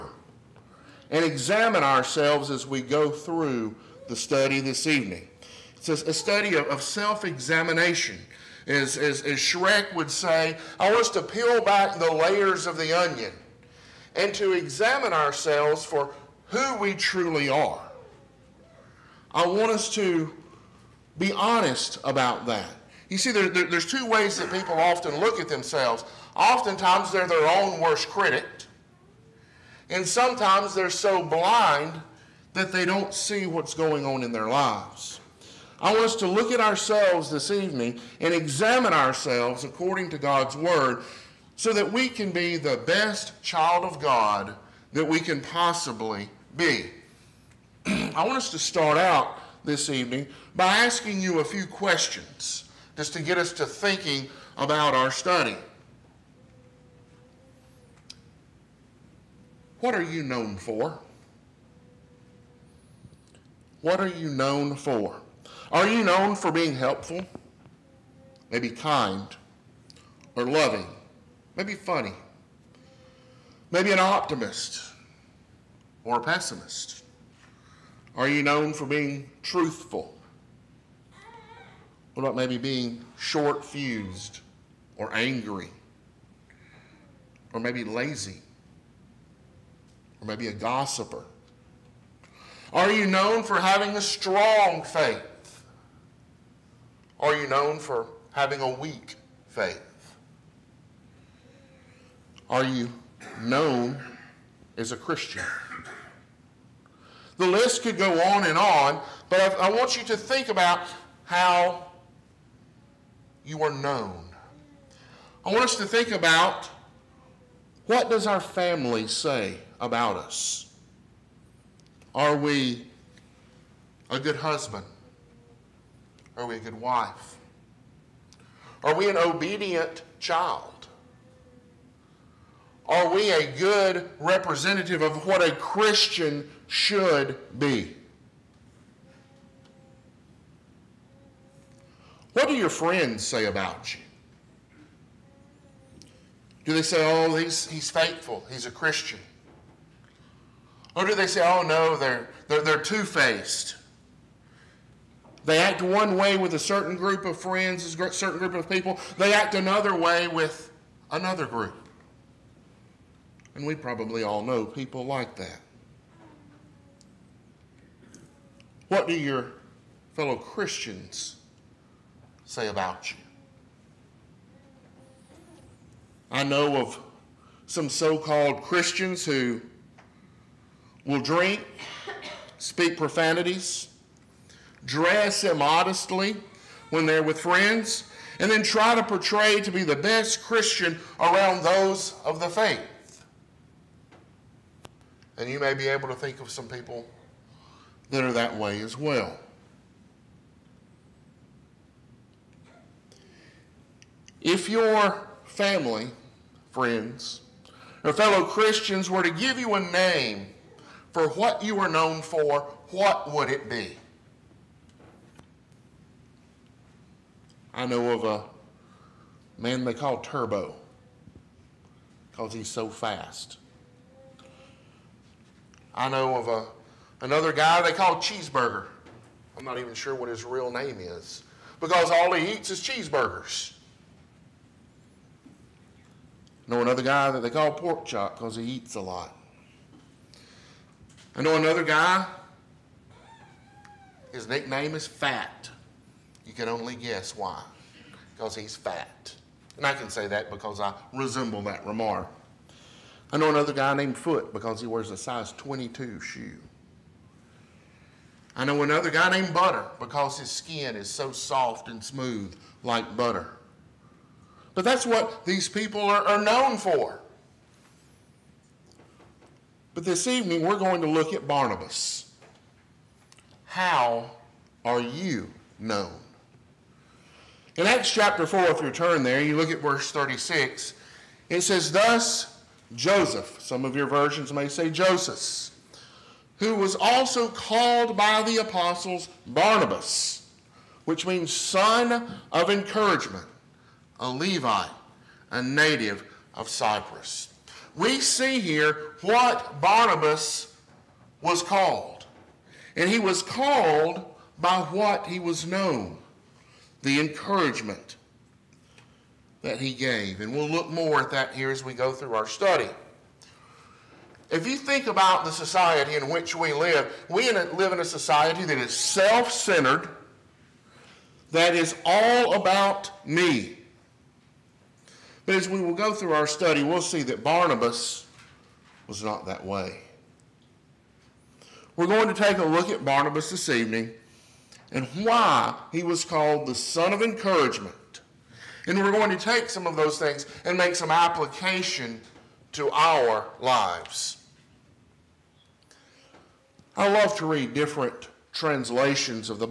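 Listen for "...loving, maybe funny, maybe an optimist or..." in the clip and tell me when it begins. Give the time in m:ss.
1:10.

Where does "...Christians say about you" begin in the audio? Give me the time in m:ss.
2:50.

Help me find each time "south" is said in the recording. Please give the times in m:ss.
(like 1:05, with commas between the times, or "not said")
not said.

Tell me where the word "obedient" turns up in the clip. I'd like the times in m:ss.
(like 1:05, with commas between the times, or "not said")
2:09.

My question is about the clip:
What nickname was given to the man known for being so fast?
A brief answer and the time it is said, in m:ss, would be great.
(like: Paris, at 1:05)
Turbo, at 3:40.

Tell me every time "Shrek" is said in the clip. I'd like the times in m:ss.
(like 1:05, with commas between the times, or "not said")
0:09.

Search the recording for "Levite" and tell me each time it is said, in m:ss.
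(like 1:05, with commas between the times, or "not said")
4:54.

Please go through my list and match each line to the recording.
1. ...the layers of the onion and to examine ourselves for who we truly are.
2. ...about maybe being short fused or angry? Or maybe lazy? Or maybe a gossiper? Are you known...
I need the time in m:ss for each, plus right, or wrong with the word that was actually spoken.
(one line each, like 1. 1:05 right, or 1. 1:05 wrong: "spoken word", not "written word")
1. 0:11 right
2. 1:22 right.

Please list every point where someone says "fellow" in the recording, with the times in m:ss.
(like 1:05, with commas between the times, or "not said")
2:50, 3:28.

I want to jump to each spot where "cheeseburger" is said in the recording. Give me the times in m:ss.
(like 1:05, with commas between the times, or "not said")
3:48, 3:52.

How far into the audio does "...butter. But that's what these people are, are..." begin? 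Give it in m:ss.
4:23.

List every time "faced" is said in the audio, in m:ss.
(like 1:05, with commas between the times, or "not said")
2:33.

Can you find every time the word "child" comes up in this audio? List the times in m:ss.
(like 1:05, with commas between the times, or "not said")
0:43, 2:10.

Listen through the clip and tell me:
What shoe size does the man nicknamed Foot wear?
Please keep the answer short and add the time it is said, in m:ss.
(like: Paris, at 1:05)
22, at 4:15.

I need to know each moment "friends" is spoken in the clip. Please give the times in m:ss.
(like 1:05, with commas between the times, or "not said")
2:22, 2:37, 3:07, 3:26.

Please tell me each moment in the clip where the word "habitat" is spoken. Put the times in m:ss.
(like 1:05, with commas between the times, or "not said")
not said.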